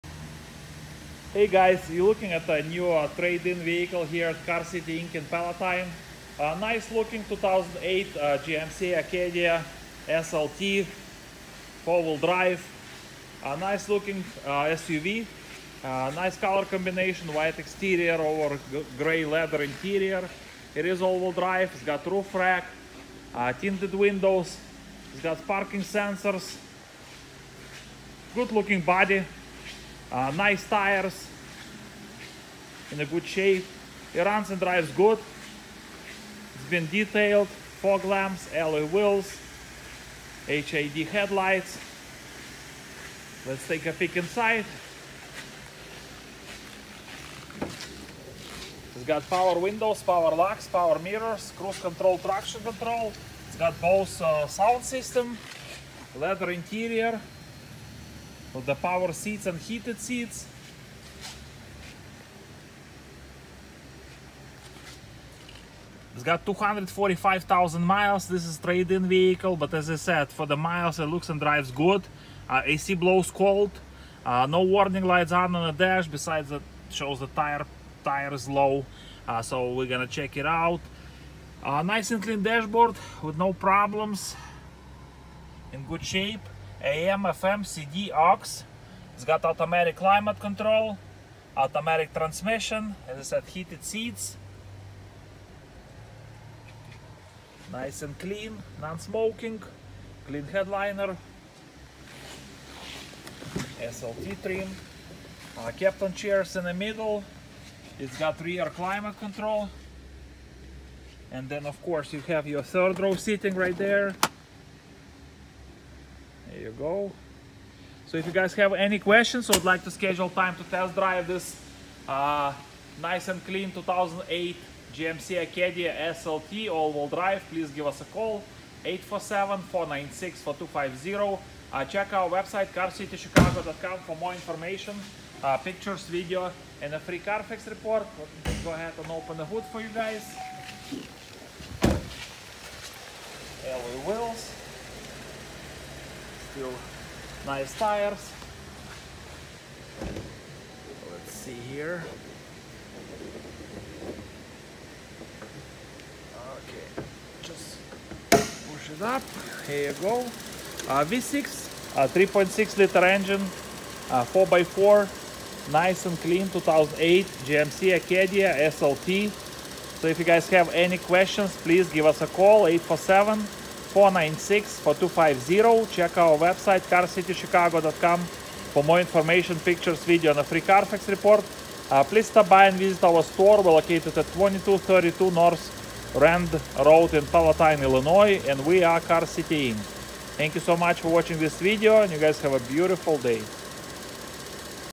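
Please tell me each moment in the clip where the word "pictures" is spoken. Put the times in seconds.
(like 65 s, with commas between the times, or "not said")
135 s, 179 s.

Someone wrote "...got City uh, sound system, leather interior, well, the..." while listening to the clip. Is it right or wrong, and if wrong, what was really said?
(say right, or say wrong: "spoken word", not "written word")
wrong: "Bose", not "City".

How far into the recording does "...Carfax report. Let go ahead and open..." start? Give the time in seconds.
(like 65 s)
137 s.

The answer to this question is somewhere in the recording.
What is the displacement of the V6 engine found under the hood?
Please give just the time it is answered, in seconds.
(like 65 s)
162 s.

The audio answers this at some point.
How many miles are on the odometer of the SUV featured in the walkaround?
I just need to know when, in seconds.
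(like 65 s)
66 s.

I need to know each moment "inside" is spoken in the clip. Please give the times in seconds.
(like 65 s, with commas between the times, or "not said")
44 s.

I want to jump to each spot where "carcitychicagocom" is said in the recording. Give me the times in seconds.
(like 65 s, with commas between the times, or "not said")
132 s, 176 s.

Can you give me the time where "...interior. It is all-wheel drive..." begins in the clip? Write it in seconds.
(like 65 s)
19 s.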